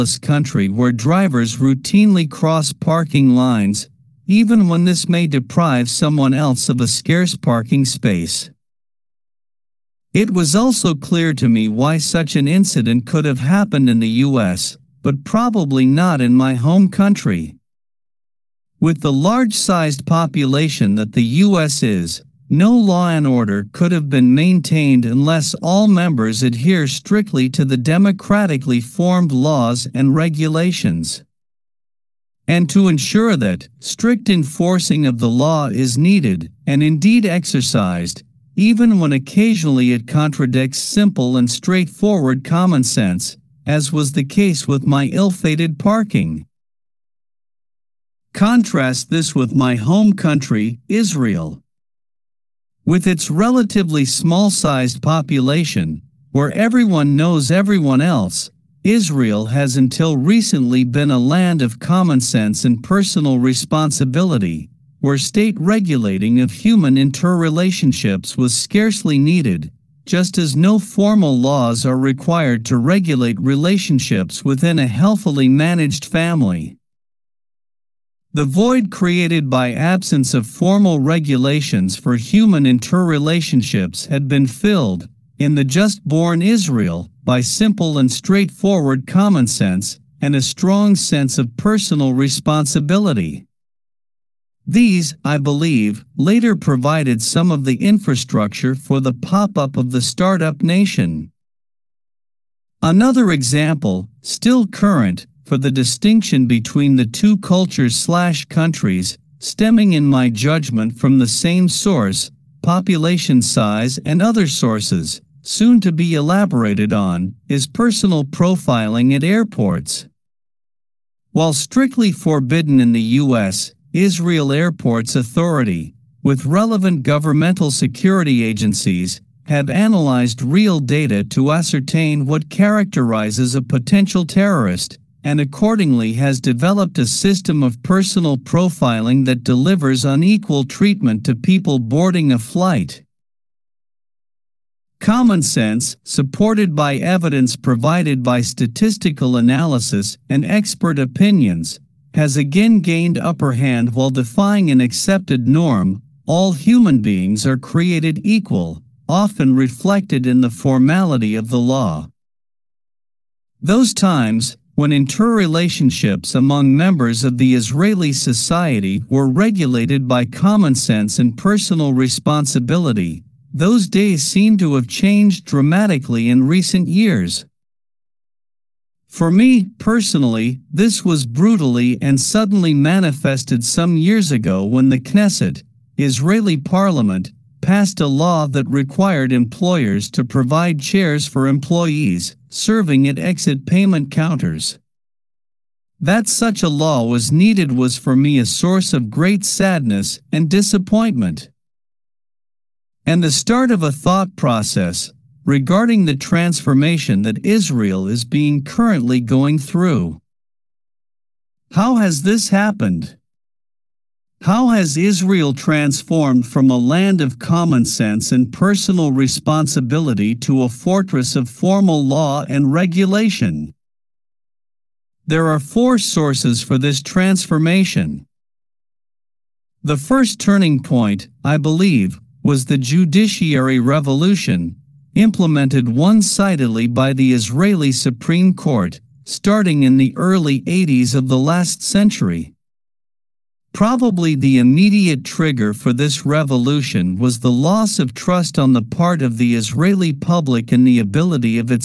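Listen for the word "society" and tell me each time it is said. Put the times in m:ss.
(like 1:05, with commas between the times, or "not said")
2:48.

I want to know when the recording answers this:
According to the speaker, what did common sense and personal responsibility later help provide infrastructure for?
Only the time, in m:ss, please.
1:39.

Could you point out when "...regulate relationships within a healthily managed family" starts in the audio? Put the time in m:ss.
1:12.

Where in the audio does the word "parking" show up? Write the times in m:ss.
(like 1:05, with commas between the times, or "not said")
0:02, 0:07, 0:45.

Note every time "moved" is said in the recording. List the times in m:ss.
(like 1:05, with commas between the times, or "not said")
not said.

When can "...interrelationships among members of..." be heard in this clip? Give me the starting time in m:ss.
2:44.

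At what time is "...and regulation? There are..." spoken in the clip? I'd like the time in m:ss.
3:42.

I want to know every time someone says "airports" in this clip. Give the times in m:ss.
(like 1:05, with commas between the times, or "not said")
1:59, 2:04.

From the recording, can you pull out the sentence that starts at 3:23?
And the start of a thought process regarding the transformation that Israel is being currently going through.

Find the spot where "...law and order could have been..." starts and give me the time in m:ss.
0:22.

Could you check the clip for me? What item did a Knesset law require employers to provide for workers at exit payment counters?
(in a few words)
chairs.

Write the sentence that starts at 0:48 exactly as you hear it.
Contrast this with my home country, Israel.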